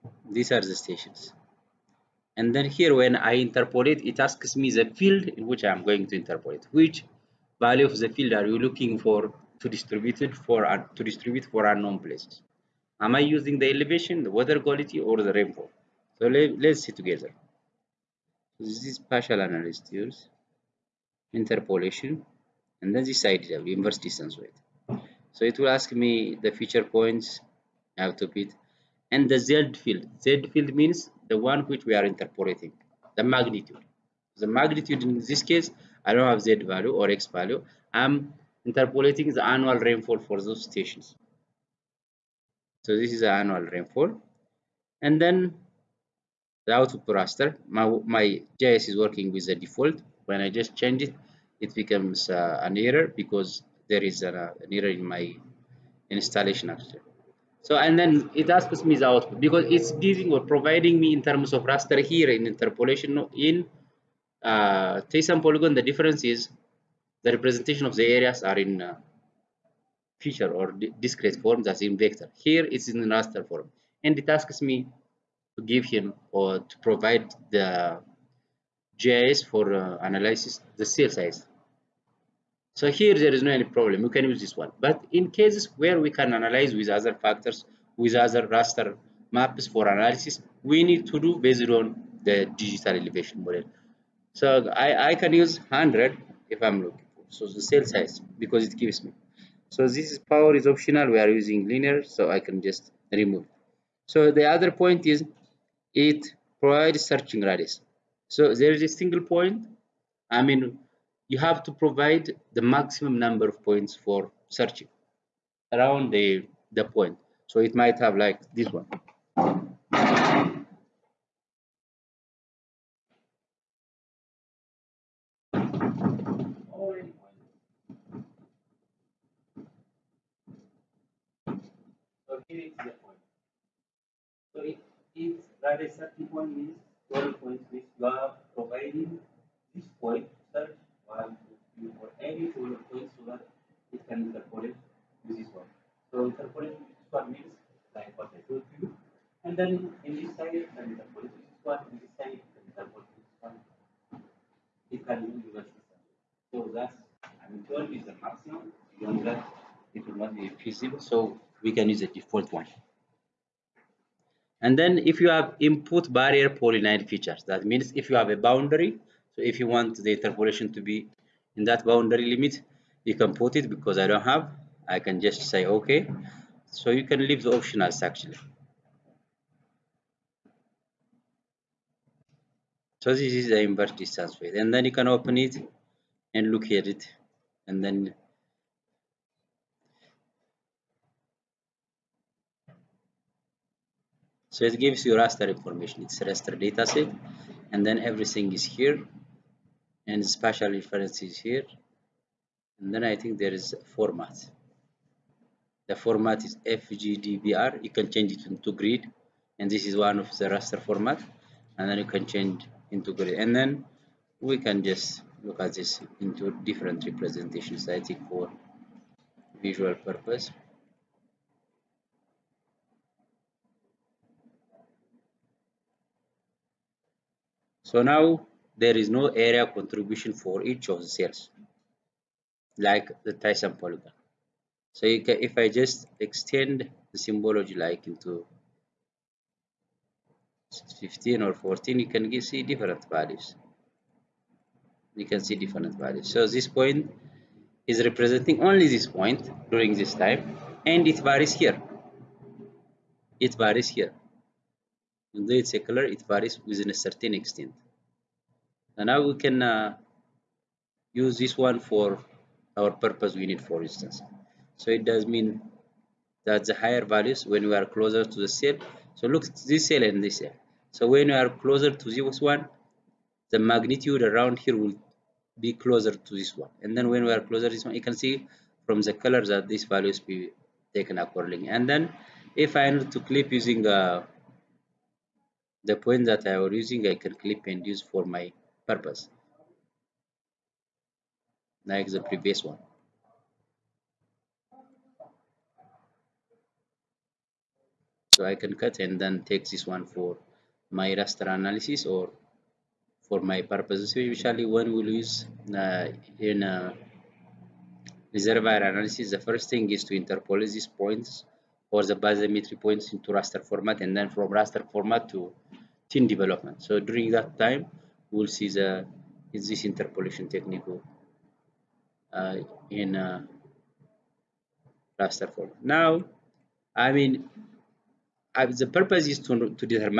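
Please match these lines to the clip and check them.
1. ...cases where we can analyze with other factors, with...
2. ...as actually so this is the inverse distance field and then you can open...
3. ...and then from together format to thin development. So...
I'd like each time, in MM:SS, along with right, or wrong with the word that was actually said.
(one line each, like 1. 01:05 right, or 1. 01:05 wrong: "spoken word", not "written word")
1. 01:25 right
2. 02:57 right
3. 05:13 wrong: "raster", not "together".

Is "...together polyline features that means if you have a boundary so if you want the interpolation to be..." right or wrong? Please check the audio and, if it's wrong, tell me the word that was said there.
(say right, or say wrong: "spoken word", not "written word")
wrong: "barrier", not "together".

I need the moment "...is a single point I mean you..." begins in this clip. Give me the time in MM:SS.
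01:48.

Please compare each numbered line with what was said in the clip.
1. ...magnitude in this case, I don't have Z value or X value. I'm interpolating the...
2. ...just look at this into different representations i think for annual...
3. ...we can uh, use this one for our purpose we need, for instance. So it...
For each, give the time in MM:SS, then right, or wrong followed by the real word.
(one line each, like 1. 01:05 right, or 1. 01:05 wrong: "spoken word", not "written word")
1. 00:34 right
2. 03:34 wrong: "visual", not "annual"
3. 04:19 right.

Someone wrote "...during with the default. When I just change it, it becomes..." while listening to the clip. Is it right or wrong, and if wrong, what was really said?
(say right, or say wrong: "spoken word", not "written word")
wrong: "working", not "during".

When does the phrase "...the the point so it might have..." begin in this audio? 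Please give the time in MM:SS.
01:56.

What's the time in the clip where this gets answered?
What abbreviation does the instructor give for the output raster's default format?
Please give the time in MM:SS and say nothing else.
03:26.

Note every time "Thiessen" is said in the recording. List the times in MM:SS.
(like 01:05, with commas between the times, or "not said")
01:05, 03:53.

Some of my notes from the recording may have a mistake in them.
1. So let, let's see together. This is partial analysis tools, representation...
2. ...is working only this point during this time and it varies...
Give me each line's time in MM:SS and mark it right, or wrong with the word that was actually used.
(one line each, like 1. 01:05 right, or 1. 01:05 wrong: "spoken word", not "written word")
1. 00:16 wrong: "interpolation", not "representation"
2. 04:07 wrong: "representing", not "working".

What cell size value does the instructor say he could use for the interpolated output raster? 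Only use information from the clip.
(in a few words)
100.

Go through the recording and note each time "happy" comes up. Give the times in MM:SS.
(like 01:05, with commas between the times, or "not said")
not said.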